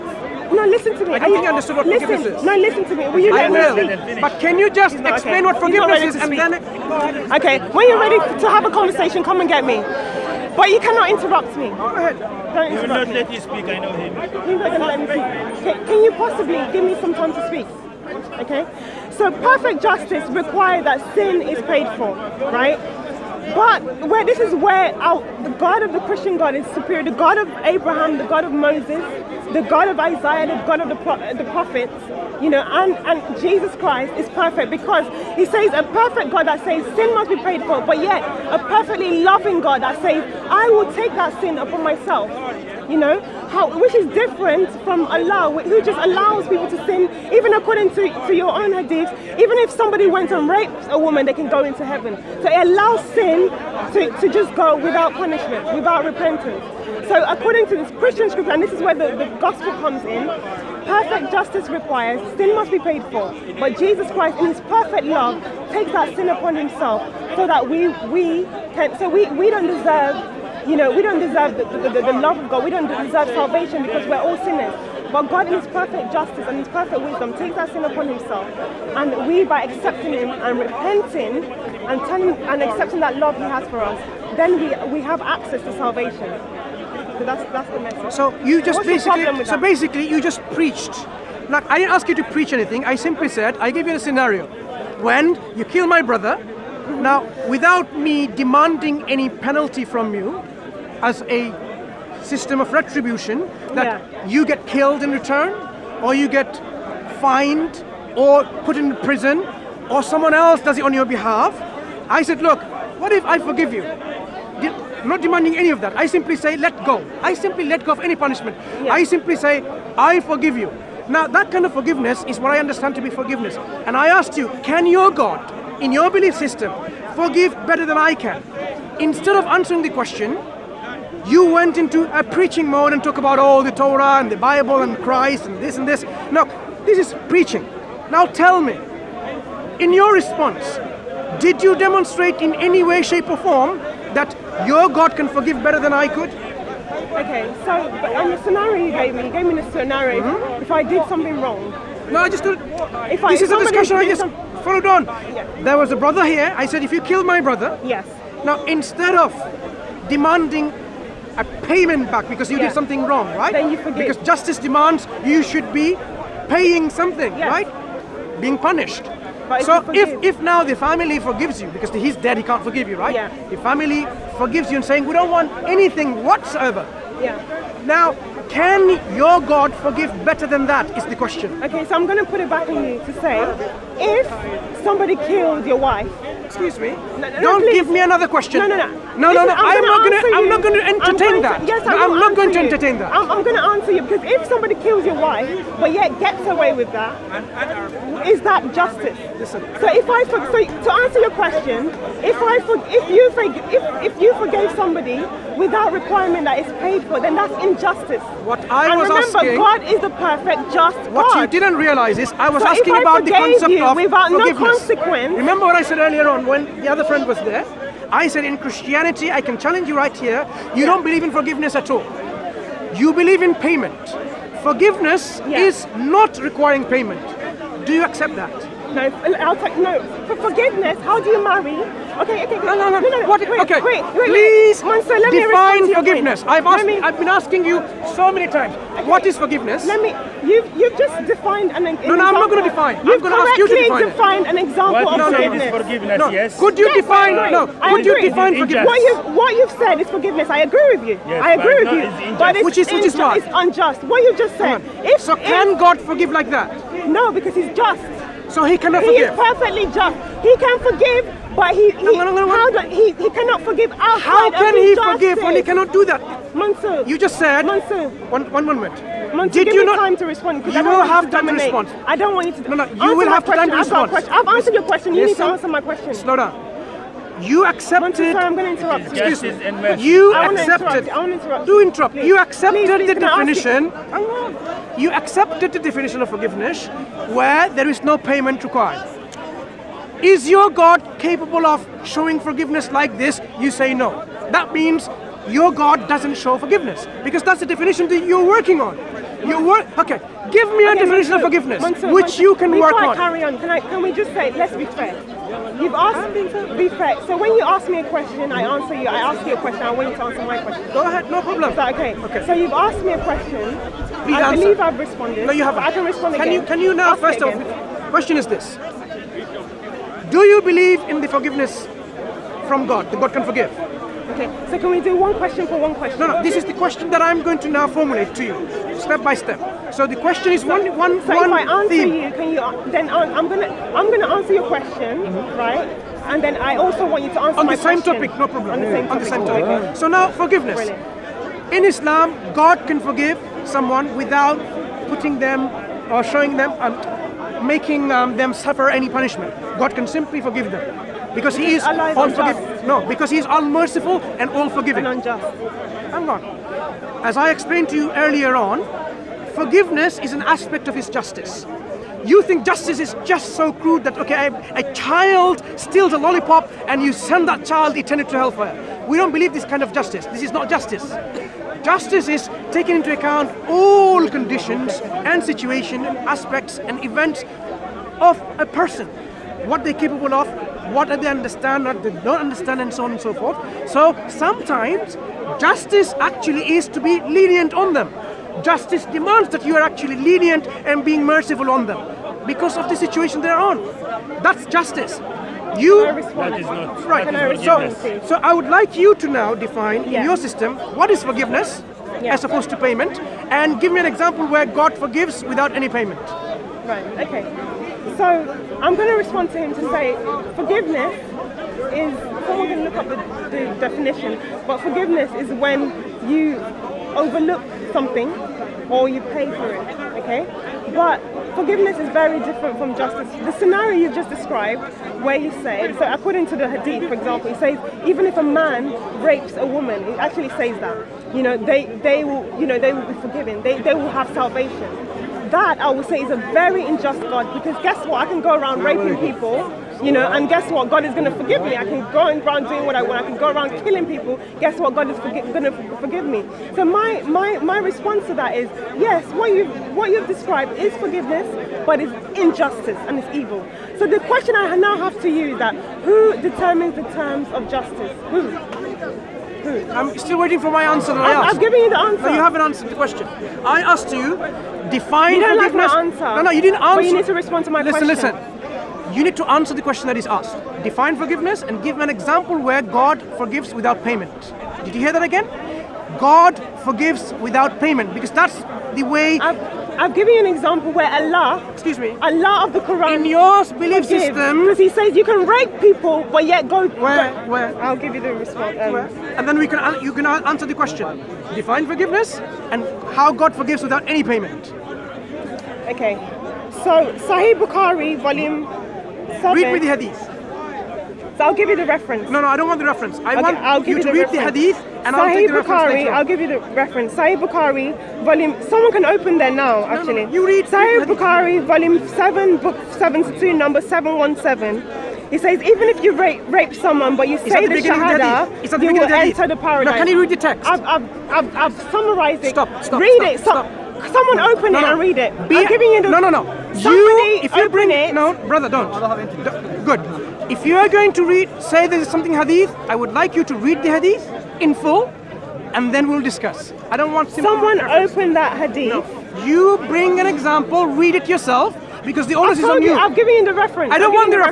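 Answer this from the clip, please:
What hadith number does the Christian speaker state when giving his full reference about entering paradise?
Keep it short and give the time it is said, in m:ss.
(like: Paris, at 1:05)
717, at 8:33.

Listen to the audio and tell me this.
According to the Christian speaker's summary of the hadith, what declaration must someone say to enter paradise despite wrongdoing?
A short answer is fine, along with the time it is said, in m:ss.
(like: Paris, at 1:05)
Shahada, at 8:37.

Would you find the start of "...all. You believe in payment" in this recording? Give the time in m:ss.
3:41.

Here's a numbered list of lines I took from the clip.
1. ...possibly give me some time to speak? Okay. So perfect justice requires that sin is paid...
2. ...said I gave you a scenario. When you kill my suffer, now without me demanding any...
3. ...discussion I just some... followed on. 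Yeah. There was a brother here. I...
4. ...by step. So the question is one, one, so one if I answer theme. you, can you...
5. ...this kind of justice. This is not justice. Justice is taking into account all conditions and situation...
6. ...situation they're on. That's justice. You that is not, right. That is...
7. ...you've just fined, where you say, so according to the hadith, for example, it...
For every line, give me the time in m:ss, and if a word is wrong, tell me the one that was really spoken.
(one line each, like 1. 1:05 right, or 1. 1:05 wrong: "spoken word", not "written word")
1. 0:16 right
2. 1:33 wrong: "brother", not "suffer"
3. 2:33 right
4. 5:29 right
5. 6:09 right
6. 6:32 right
7. 7:03 wrong: "described", not "fined".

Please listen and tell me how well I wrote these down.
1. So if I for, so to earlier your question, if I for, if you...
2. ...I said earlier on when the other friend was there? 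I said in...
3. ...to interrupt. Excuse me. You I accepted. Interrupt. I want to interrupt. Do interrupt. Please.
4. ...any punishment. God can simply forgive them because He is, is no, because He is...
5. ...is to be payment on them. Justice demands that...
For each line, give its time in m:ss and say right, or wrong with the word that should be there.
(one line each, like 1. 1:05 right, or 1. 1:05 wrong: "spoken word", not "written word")
1. 3:19 wrong: "answer", not "earlier"
2. 3:35 right
3. 4:38 right
4. 5:48 right
5. 6:26 wrong: "lenient", not "payment".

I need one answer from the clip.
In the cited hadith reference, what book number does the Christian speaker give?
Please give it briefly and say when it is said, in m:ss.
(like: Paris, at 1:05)
72, at 8:32.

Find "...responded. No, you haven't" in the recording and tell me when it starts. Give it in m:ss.
5:14.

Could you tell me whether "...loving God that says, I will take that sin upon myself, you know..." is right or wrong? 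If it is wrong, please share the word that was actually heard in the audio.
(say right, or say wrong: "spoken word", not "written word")
right.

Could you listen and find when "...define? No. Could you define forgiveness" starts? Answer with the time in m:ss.
4:06.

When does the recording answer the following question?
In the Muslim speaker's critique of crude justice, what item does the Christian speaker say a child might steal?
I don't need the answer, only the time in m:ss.
6:06.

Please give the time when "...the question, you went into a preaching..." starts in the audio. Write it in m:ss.
2:09.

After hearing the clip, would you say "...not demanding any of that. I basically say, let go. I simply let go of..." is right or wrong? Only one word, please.
wrong.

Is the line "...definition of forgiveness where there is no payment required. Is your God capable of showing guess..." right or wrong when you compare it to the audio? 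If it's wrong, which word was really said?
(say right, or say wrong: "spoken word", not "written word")
wrong: "forgiveness", not "guess".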